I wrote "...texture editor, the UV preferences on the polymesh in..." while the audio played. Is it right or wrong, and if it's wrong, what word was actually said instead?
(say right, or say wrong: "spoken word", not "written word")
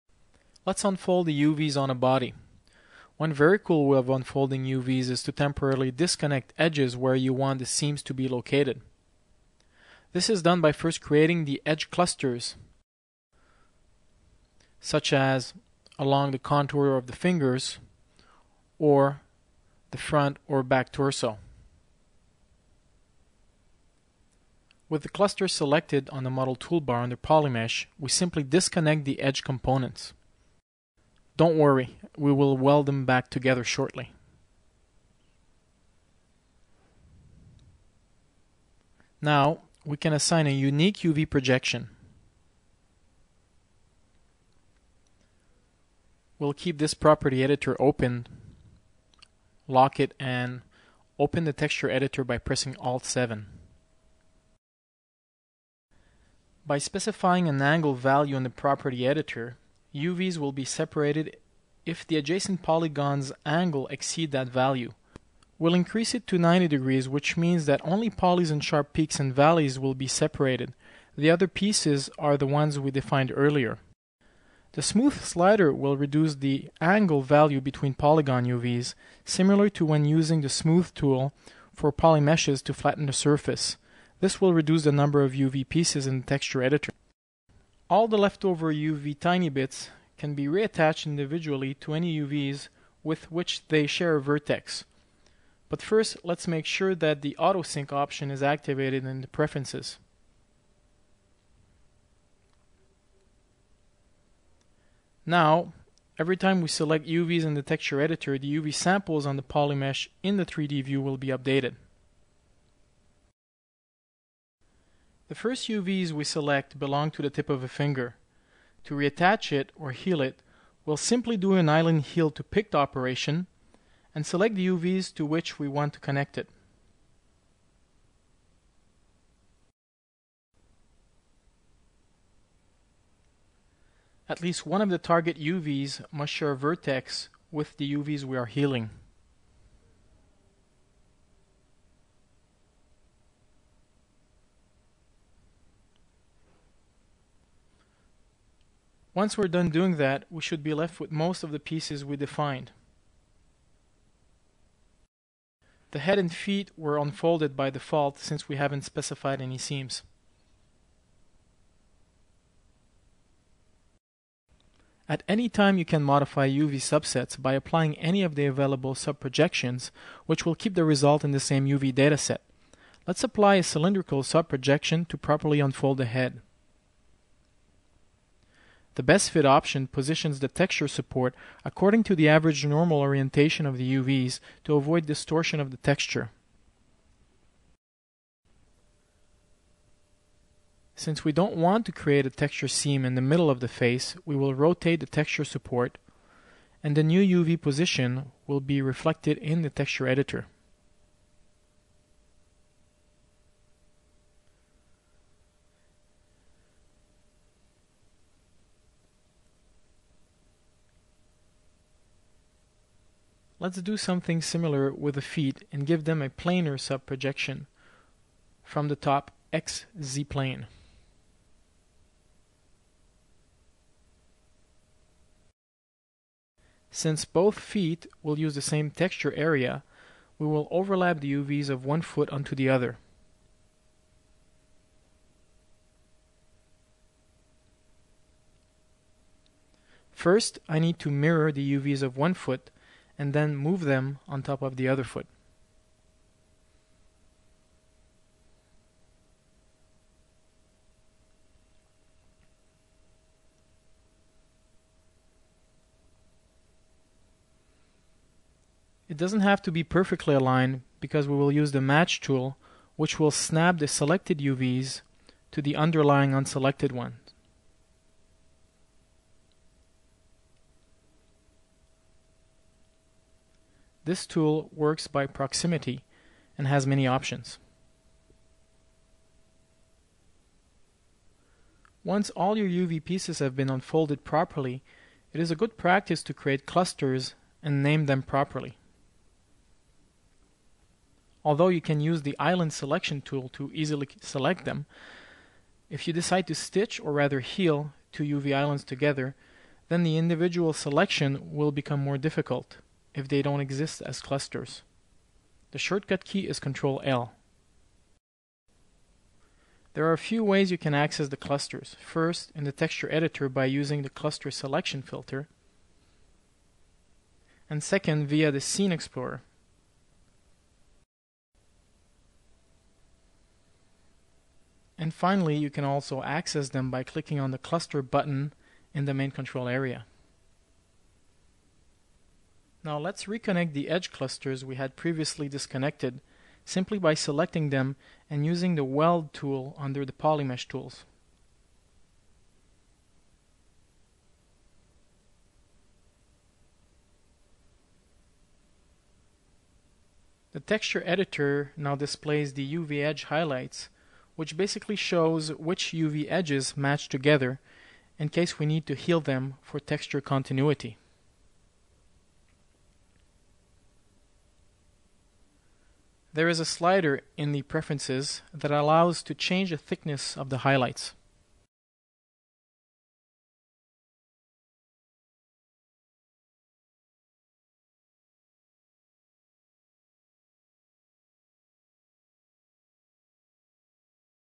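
wrong: "samples", not "preferences".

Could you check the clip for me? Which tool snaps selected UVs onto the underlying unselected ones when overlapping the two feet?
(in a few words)
match tool.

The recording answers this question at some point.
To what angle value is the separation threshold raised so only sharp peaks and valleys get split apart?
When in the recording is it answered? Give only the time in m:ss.
1:06.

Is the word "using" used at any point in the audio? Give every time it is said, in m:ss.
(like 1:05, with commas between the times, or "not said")
1:20, 5:13, 5:38.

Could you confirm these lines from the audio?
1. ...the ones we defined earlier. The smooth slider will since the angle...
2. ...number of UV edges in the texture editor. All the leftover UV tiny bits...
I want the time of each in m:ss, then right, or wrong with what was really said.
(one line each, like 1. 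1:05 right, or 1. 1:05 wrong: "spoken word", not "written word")
1. 1:12 wrong: "reduce", not "since"
2. 1:24 wrong: "pieces", not "edges".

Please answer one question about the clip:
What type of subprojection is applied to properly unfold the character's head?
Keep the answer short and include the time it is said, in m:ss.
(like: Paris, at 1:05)
cylindrical, at 2:53.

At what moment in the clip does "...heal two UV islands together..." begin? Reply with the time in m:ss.
4:57.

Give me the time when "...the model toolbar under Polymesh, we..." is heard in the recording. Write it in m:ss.
0:26.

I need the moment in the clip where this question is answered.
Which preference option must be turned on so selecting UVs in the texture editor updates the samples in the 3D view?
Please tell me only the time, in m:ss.
1:37.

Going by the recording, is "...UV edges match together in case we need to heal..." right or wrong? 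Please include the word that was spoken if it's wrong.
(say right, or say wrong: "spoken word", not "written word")
right.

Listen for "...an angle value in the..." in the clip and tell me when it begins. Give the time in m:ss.
0:57.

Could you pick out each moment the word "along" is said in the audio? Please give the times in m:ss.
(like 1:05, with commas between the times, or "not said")
0:15.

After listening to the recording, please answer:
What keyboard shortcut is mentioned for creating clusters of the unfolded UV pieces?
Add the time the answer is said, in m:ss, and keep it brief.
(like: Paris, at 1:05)
Ctrl-L, at 5:06.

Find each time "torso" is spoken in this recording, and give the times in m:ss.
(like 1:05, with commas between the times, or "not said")
0:20.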